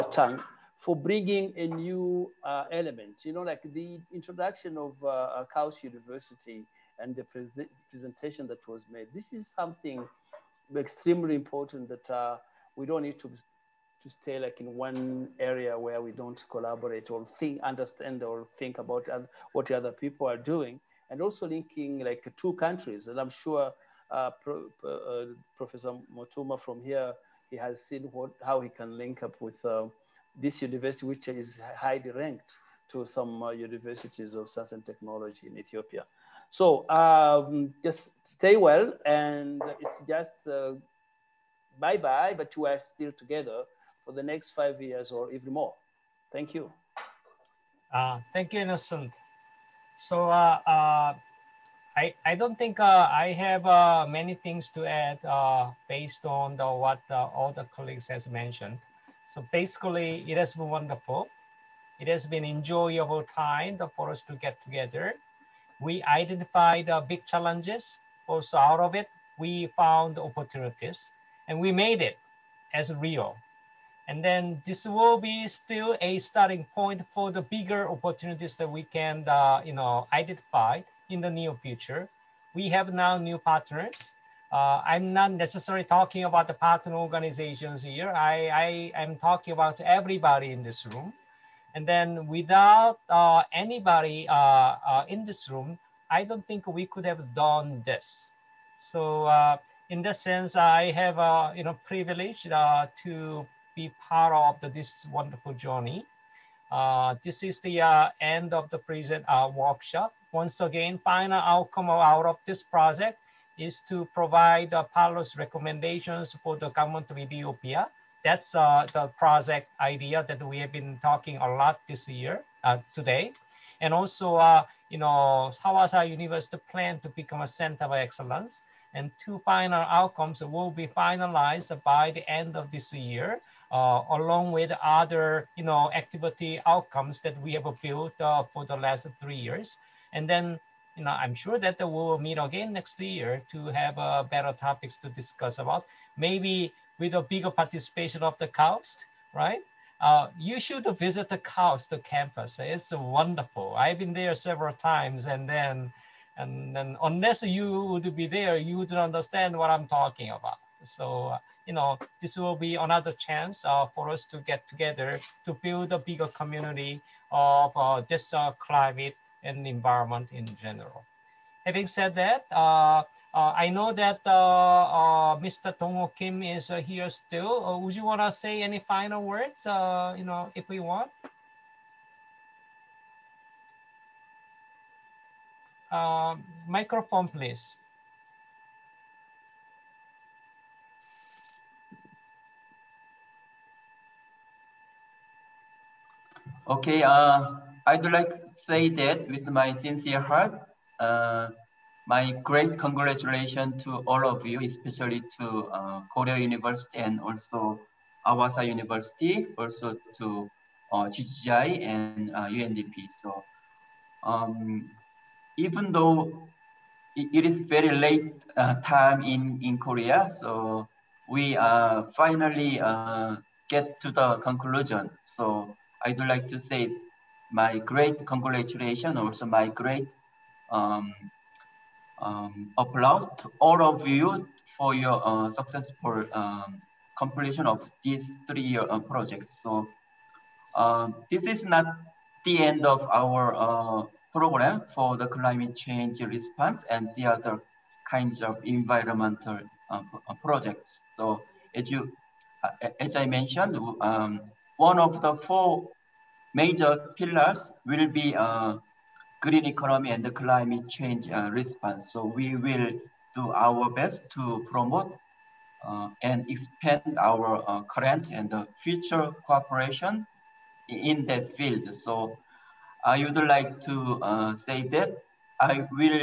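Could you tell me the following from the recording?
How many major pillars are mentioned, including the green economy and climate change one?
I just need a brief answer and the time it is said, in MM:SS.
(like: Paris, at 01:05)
4, at 04:15.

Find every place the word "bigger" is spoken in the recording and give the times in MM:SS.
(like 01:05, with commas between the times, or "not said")
01:17, 02:27, 02:45.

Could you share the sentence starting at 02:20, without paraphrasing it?
And then you know, I'm sure that we will meet again next year to have uh, better topics to discuss about.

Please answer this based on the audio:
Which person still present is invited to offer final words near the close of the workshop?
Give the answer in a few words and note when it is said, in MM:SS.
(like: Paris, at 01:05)
Dongo Kim, at 02:55.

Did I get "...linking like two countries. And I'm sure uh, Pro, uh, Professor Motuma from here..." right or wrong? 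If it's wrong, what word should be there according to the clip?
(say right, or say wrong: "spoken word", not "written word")
right.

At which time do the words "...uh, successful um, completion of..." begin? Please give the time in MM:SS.
03:55.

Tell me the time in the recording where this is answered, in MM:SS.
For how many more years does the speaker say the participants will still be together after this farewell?
00:44.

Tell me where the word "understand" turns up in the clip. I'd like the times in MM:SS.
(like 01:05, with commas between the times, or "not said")
00:17, 02:38.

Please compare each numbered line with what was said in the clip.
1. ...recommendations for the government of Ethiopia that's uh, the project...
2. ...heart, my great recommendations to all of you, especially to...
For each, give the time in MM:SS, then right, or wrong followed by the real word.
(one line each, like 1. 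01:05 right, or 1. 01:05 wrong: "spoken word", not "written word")
1. 01:55 right
2. 03:20 wrong: "congratulations", not "recommendations".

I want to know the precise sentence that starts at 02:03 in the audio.
And also, uh, you know, Hawassa University plan to become a center of excellence.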